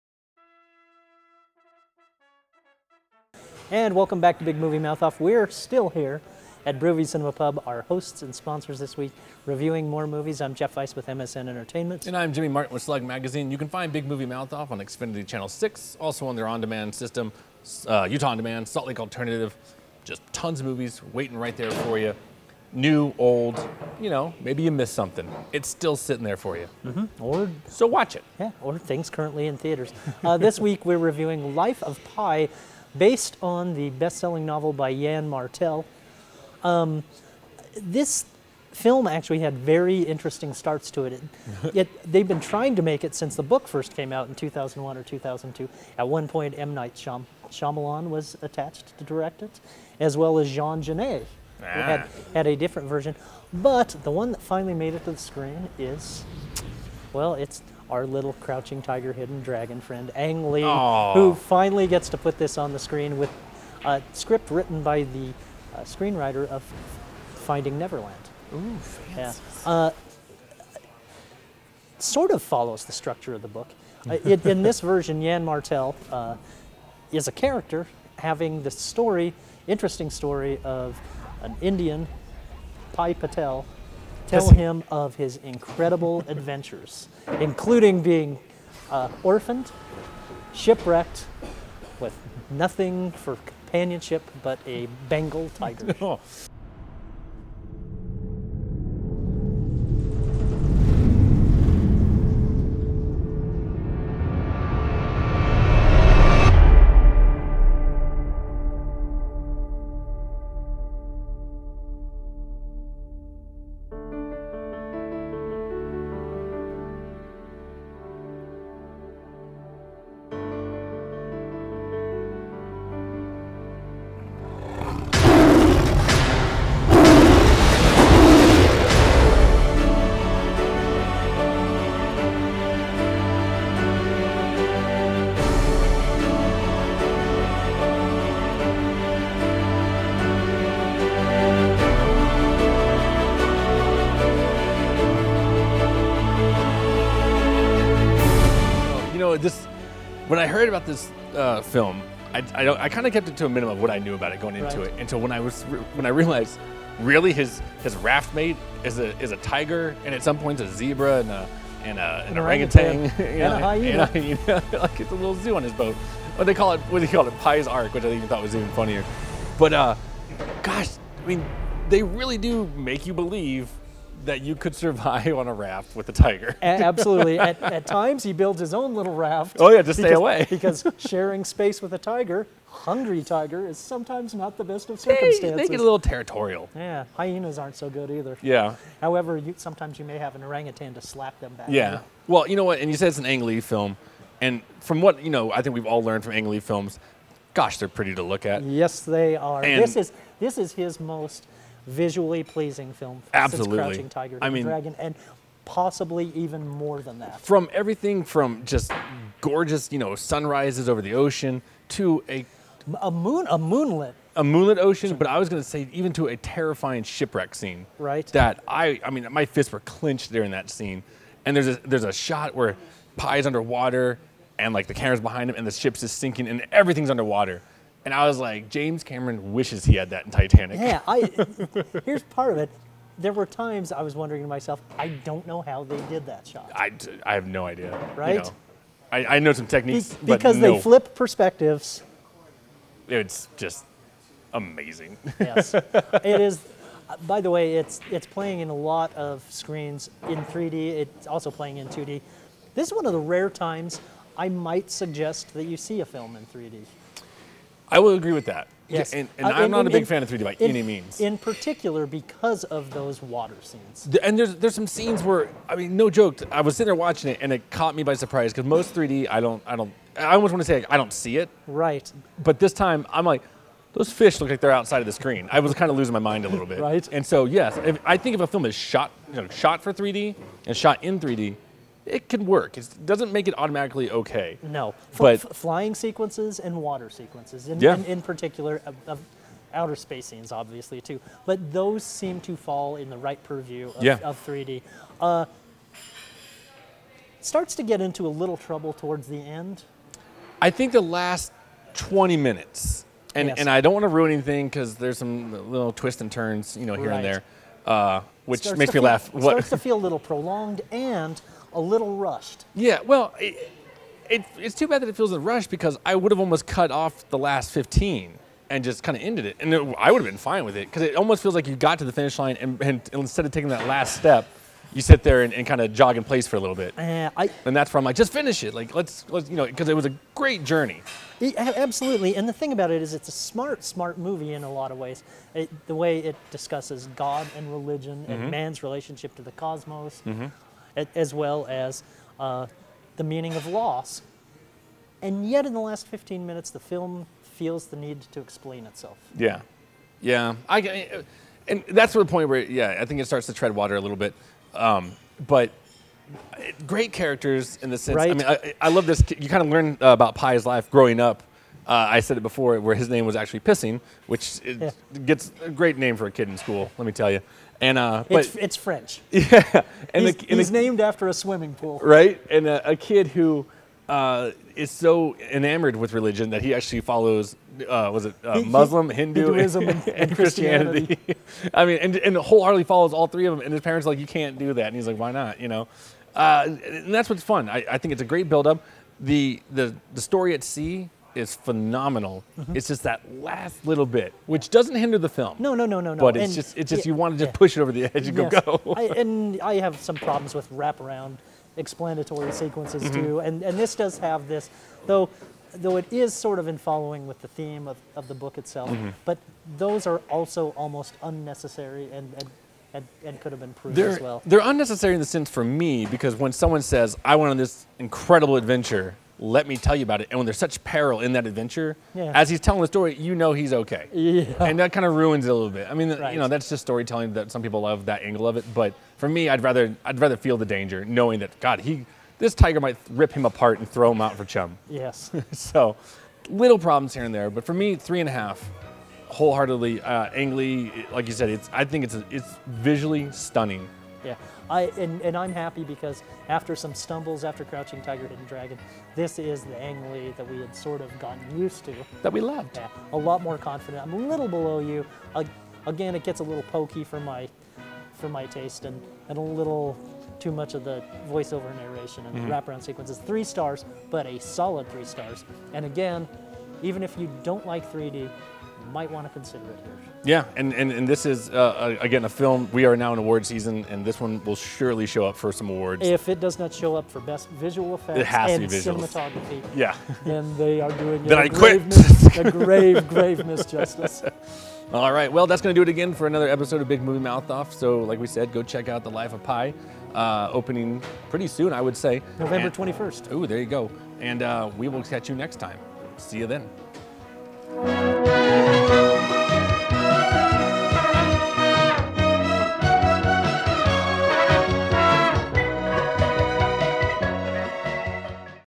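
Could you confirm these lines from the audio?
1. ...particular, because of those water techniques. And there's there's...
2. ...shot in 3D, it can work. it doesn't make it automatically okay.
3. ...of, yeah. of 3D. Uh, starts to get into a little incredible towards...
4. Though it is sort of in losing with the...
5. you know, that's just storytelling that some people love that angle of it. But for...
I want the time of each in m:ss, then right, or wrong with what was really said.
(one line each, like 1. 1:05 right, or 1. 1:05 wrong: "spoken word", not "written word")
1. 4:21 wrong: "scenes", not "techniques"
2. 4:40 right
3. 4:53 wrong: "trouble", not "incredible"
4. 6:45 wrong: "following", not "losing"
5. 7:06 right.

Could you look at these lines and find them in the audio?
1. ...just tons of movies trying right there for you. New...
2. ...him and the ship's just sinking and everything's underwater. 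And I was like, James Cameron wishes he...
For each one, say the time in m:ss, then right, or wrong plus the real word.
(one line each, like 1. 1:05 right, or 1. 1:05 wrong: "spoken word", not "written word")
1. 0:20 wrong: "waiting", not "trying"
2. 3:45 right.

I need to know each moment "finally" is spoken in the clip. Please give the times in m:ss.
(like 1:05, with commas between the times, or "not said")
0:54, 1:01.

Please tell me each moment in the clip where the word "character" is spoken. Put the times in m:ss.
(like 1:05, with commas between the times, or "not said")
1:17, 5:57.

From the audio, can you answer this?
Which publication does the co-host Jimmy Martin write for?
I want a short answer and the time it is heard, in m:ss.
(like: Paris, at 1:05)
Slug Magazine, at 0:12.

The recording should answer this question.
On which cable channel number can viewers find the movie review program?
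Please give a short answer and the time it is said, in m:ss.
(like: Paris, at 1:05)
6, at 0:15.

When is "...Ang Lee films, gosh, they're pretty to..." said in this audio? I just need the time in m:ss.
3:16.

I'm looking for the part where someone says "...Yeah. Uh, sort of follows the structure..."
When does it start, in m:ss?
1:09.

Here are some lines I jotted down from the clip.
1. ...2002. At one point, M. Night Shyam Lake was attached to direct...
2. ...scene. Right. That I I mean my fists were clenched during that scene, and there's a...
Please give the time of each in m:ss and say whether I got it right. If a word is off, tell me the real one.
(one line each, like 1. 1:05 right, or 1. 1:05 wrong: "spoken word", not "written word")
1. 0:45 wrong: "Shyamalan", not "Lake"
2. 3:37 right.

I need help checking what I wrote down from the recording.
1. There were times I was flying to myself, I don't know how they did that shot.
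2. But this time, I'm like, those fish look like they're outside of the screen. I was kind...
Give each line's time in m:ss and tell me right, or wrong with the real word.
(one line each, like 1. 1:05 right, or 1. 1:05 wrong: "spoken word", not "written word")
1. 3:53 wrong: "wondering", not "flying"
2. 4:32 right.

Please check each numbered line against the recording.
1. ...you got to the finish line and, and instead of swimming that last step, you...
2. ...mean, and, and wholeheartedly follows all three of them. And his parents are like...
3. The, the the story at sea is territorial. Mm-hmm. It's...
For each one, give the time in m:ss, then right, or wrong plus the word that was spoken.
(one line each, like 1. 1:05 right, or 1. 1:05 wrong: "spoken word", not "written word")
1. 5:21 wrong: "taking", not "swimming"
2. 6:21 right
3. 6:29 wrong: "phenomenal", not "territorial".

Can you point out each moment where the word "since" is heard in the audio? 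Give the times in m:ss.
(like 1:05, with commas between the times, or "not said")
0:43, 3:23.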